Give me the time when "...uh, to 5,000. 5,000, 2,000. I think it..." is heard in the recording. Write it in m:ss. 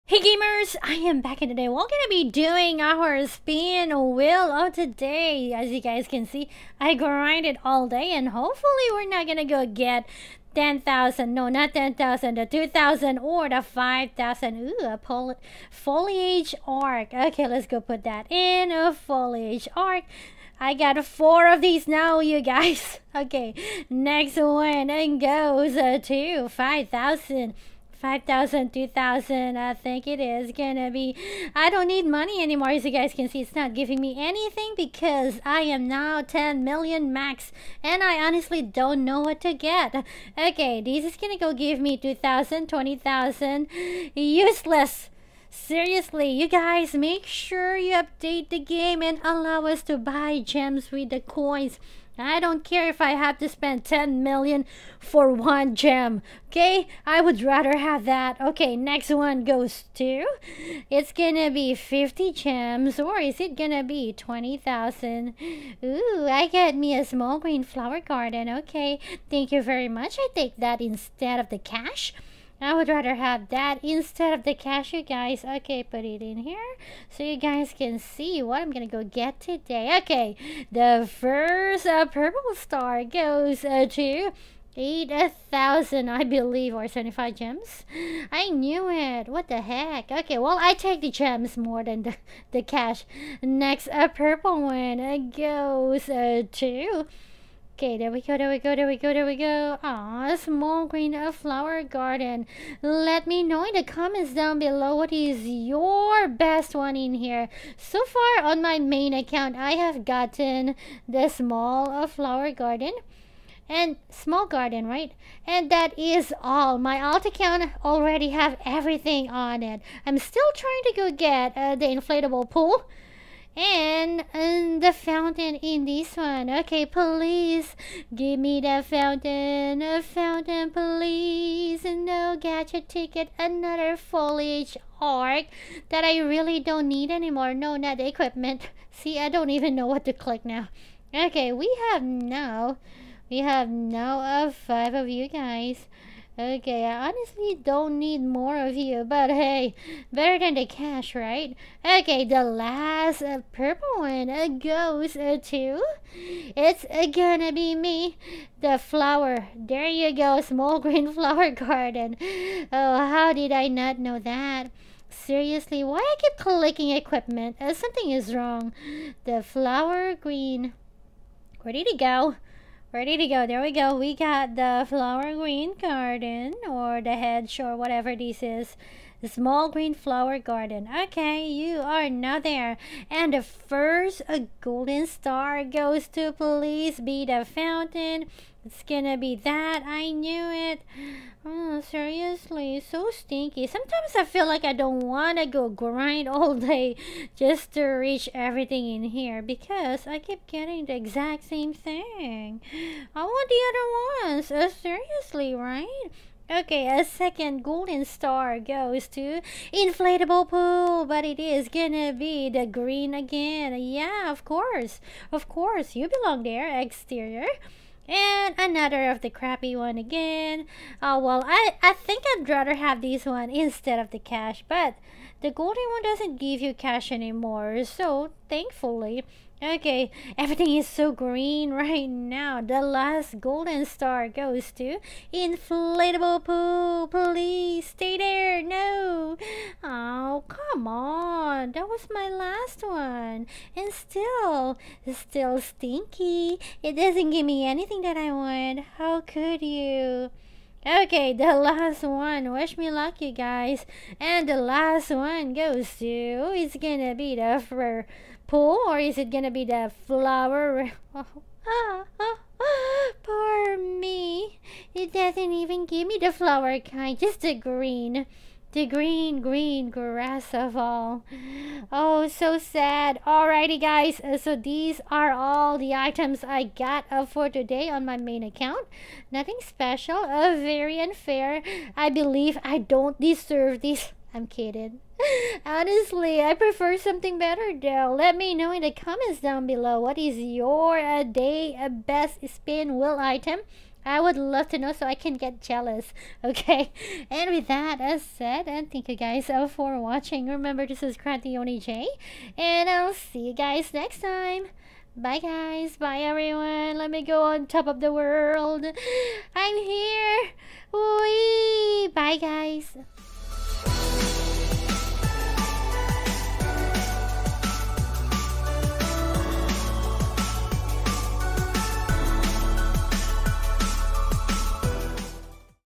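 0:25.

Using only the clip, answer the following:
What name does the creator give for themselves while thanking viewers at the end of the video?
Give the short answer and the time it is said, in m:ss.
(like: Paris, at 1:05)
Krantioni J., at 5:01.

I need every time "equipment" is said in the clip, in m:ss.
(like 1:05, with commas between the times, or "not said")
2:18, 2:46.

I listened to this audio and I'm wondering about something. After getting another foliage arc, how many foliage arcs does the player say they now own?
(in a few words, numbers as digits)
five.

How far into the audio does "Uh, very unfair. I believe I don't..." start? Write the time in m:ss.
4:40.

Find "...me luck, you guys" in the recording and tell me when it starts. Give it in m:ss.
4:12.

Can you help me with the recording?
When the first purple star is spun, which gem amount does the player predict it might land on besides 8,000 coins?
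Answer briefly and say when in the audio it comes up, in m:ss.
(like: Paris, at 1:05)
75 gems, at 1:26.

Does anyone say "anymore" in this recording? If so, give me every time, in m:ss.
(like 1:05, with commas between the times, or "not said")
0:32, 2:17, 3:47.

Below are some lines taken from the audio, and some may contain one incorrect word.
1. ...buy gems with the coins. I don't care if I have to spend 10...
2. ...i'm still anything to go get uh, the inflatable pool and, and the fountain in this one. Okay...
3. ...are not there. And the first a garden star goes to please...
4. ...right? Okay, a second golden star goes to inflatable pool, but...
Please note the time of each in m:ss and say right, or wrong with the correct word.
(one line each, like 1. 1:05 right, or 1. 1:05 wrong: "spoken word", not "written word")
1. 0:49 right
2. 2:00 wrong: "trying", not "anything"
3. 3:01 wrong: "golden", not "garden"
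4. 3:25 right.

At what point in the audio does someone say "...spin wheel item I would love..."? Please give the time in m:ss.
4:52.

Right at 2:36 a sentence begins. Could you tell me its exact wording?
It's uh, gonna be me, the flower.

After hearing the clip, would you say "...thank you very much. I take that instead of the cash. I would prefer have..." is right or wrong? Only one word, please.
wrong.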